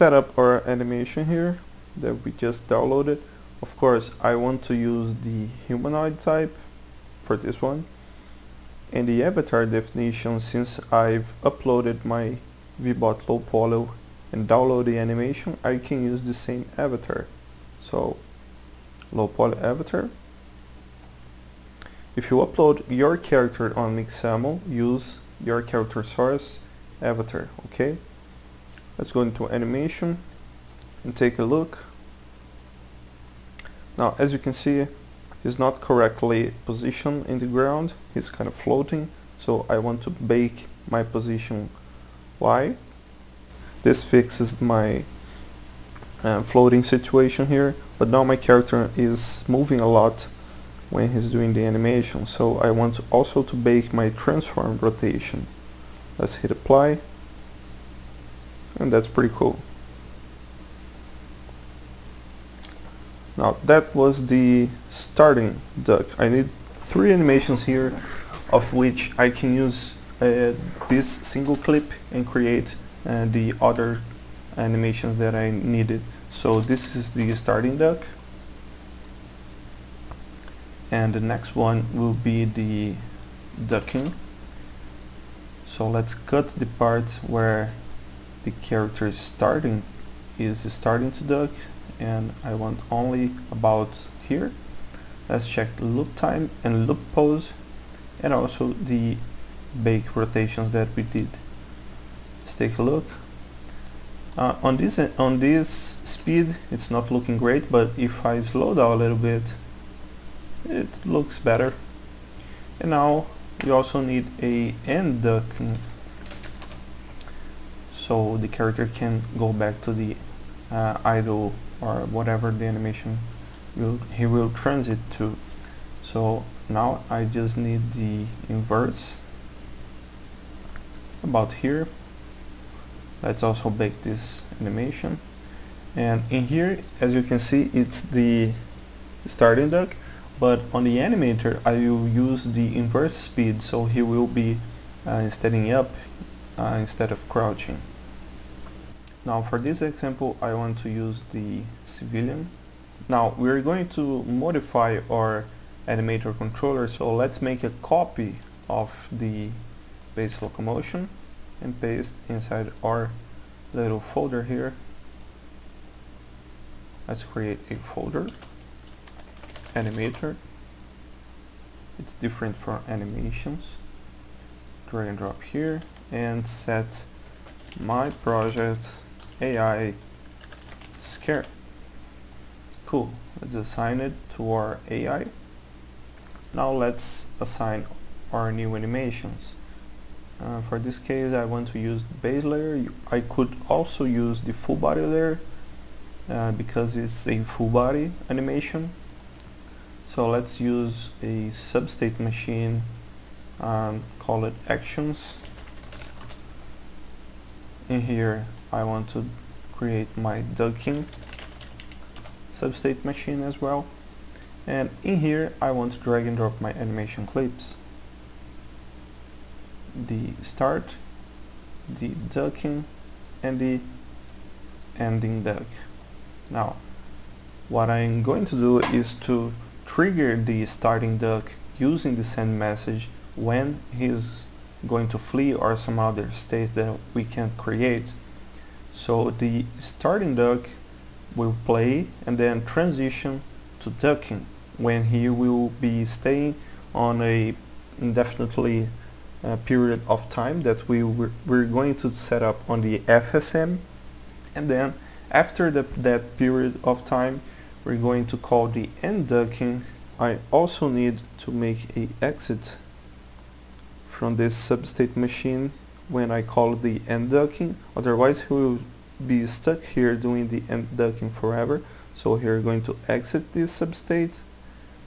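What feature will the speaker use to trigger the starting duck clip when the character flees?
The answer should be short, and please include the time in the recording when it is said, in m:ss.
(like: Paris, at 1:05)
send message, at 3:52.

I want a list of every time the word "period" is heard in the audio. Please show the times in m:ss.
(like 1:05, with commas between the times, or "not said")
4:09, 4:16.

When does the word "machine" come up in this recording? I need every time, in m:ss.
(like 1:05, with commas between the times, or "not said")
3:22, 3:33, 4:25.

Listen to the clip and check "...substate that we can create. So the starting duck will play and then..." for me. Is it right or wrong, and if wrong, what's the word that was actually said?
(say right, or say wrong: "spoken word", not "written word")
wrong: "state", not "substate".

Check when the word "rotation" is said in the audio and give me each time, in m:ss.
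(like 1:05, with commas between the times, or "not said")
0:54, 1:40.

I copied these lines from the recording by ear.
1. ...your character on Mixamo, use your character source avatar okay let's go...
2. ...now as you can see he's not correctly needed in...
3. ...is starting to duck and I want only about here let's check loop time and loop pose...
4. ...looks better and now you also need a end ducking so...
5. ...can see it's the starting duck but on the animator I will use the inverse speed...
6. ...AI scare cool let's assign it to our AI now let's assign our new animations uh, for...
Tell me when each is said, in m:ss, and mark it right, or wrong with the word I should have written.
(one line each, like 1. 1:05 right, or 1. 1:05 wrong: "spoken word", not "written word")
1. 0:22 right
2. 0:33 wrong: "positioned", not "needed"
3. 1:30 right
4. 1:51 right
5. 2:17 right
6. 2:59 right.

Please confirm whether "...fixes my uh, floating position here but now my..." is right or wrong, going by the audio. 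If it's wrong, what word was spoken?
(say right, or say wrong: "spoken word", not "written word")
wrong: "situation", not "position".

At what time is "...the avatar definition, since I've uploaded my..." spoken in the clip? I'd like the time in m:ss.
0:09.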